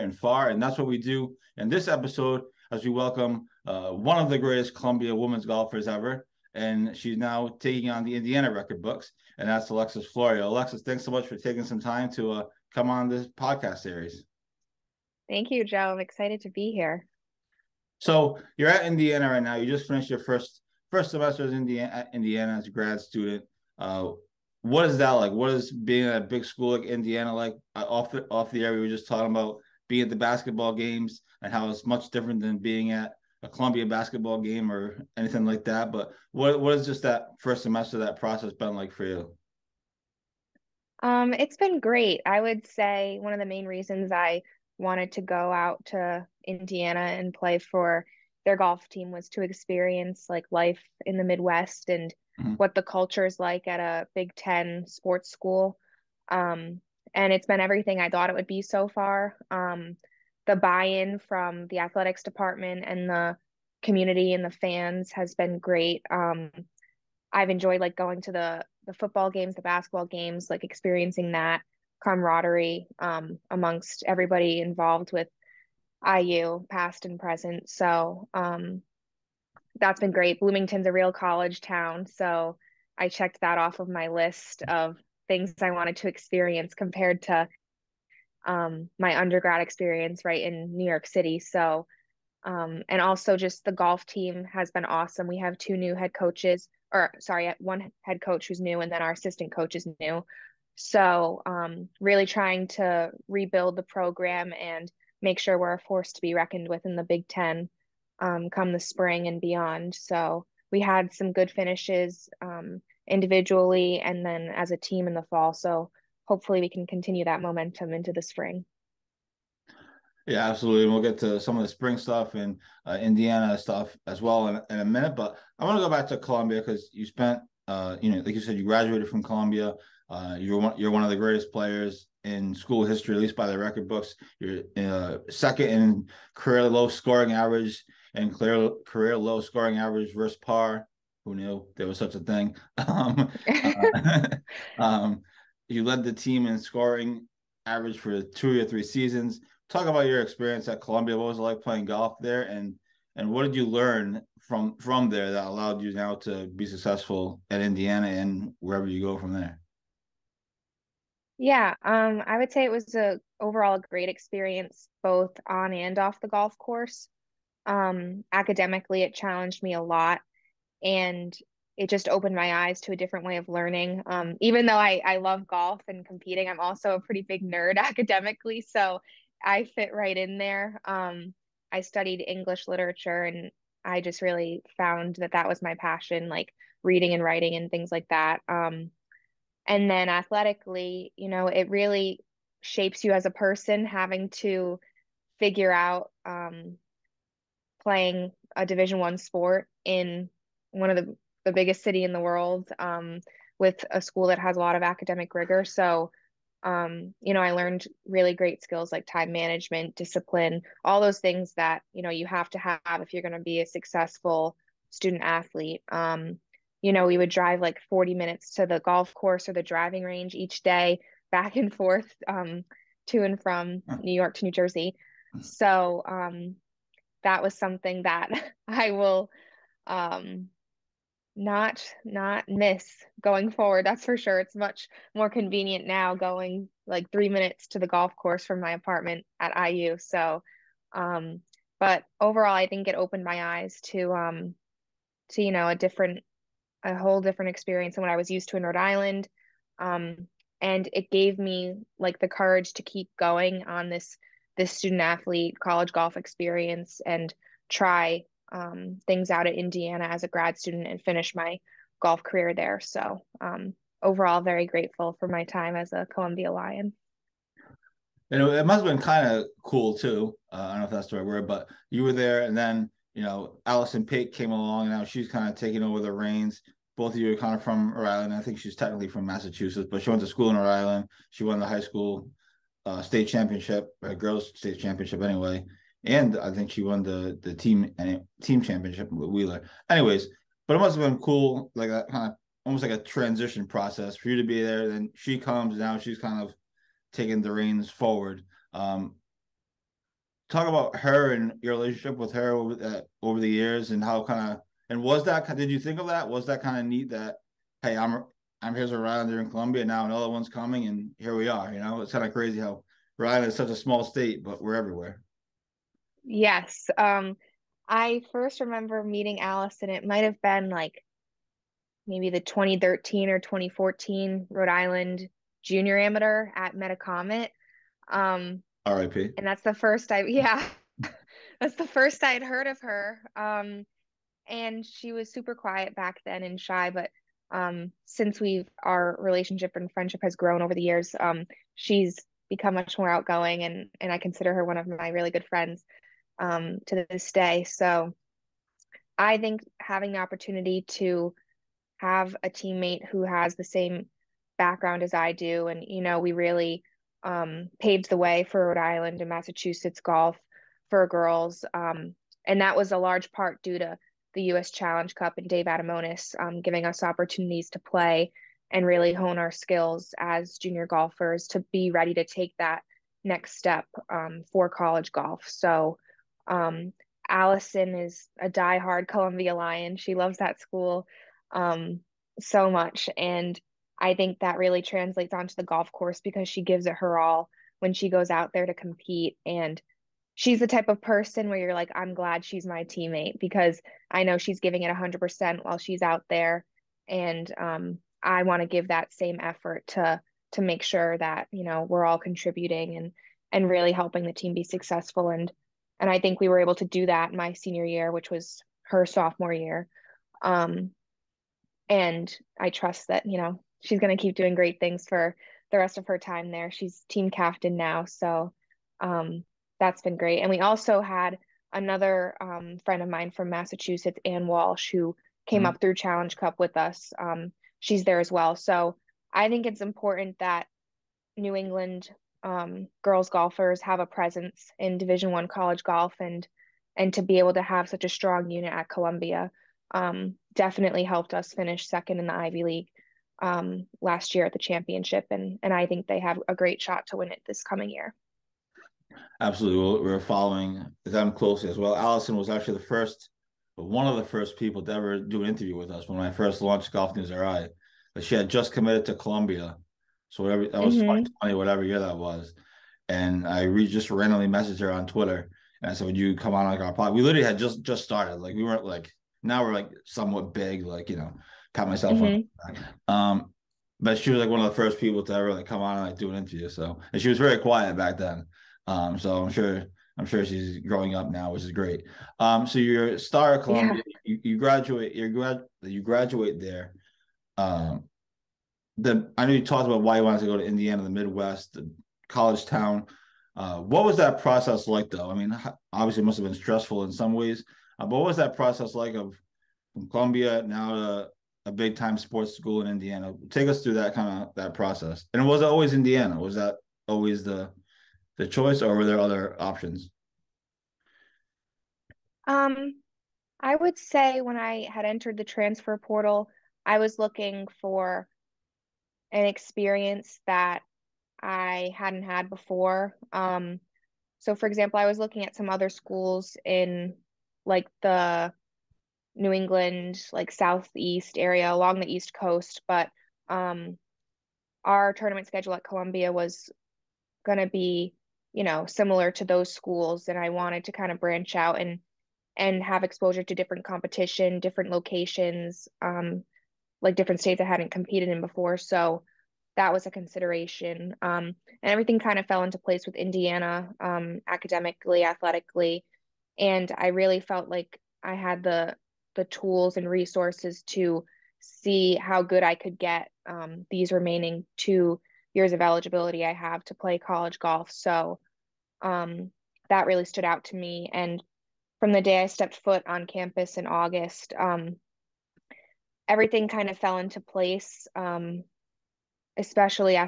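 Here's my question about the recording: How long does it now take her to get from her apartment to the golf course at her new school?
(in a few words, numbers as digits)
3 minutes.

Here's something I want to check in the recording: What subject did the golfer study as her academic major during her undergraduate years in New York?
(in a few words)
English literature.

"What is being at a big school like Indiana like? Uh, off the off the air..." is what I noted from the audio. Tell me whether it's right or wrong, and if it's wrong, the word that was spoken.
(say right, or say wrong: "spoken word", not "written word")
right.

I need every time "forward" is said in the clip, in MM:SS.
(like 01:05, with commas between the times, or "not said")
03:53, 04:57.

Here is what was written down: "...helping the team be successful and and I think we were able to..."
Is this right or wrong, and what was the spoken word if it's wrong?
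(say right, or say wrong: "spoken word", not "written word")
right.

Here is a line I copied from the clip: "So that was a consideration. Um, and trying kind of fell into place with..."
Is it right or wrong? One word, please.
wrong.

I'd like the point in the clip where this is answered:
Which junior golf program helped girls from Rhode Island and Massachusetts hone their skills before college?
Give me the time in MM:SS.
06:04.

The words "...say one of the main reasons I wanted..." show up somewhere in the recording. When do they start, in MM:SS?
00:42.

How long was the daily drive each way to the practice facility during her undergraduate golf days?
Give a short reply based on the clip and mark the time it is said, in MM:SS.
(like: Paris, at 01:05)
40 minutes, at 03:37.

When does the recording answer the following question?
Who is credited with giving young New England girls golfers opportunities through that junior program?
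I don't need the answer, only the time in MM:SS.
06:05.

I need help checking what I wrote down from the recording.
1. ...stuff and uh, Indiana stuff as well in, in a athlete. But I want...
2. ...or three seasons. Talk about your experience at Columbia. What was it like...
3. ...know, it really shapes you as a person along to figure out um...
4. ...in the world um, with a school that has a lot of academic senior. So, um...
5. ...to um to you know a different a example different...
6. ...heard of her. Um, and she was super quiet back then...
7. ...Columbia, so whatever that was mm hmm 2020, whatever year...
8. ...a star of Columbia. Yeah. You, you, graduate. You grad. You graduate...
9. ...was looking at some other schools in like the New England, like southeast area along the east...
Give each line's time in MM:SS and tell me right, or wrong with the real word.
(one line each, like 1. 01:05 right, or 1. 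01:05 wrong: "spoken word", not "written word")
1. 02:01 wrong: "minute", not "athlete"
2. 02:28 right
3. 03:11 wrong: "having", not "along"
4. 03:22 wrong: "rigor", not "senior"
5. 04:03 wrong: "whole", not "example"
6. 05:32 right
7. 07:39 right
8. 08:03 right
9. 08:45 right.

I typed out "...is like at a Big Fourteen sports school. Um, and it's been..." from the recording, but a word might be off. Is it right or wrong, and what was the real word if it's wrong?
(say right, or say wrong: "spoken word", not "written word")
wrong: "Ten", not "Fourteen".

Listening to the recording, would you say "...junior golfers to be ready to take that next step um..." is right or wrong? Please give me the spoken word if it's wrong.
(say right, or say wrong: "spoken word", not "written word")
right.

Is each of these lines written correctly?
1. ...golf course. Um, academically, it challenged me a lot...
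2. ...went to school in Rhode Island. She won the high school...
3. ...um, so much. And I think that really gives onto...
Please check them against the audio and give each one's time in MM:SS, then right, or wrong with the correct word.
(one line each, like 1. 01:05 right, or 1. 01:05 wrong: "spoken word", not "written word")
1. 02:46 right
2. 04:40 right
3. 06:21 wrong: "translates", not "gives".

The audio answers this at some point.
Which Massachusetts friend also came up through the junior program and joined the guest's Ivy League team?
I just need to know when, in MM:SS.
07:04.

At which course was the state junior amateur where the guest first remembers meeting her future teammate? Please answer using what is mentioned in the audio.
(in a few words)
Metacomet.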